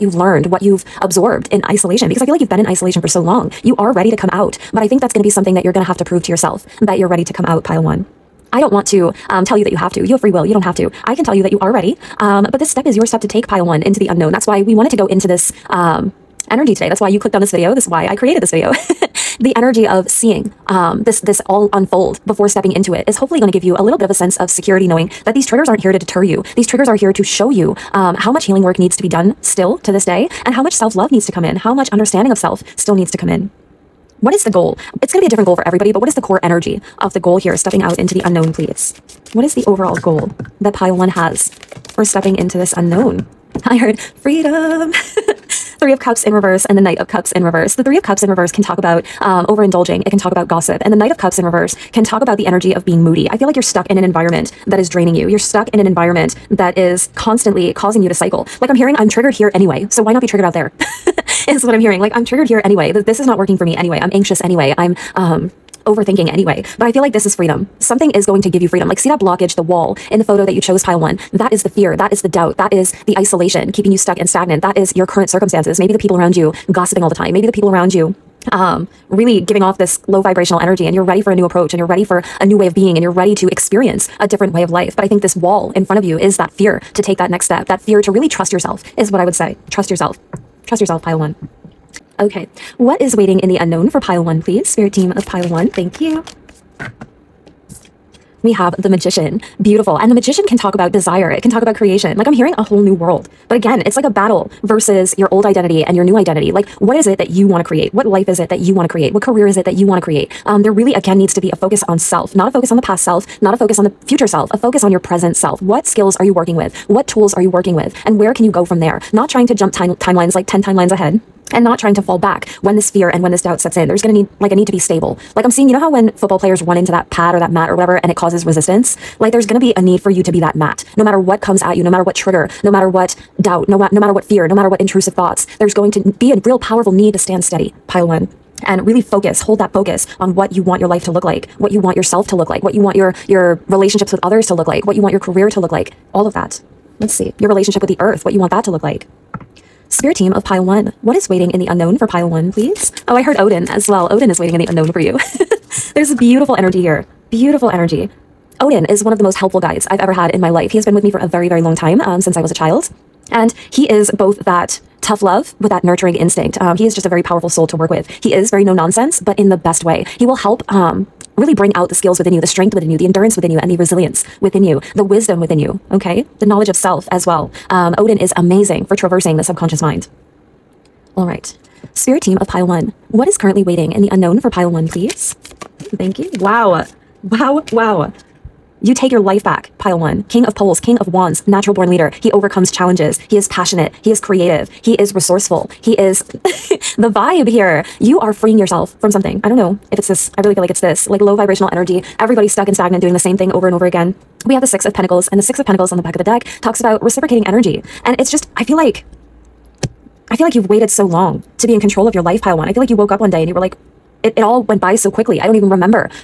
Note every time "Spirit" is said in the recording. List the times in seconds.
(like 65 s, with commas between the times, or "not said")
94 s, 149 s, 181 s.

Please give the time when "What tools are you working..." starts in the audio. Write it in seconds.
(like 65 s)
116 s.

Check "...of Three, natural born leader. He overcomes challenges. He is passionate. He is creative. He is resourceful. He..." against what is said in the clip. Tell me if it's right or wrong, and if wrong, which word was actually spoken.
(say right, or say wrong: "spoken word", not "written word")
wrong: "Wands", not "Three".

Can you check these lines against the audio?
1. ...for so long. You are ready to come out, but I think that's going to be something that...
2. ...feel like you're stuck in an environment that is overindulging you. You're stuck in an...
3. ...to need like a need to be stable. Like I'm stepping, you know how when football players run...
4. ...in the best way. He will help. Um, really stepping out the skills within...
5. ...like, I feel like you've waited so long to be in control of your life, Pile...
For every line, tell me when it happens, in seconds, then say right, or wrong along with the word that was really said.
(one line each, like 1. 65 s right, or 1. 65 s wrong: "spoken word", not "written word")
1. 2 s right
2. 53 s wrong: "draining", not "overindulging"
3. 124 s wrong: "seeing", not "stepping"
4. 169 s wrong: "bring", not "stepping"
5. 208 s right.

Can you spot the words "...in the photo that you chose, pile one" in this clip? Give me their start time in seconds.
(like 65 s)
70 s.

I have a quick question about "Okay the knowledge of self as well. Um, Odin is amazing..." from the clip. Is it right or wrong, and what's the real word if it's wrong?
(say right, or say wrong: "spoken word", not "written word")
right.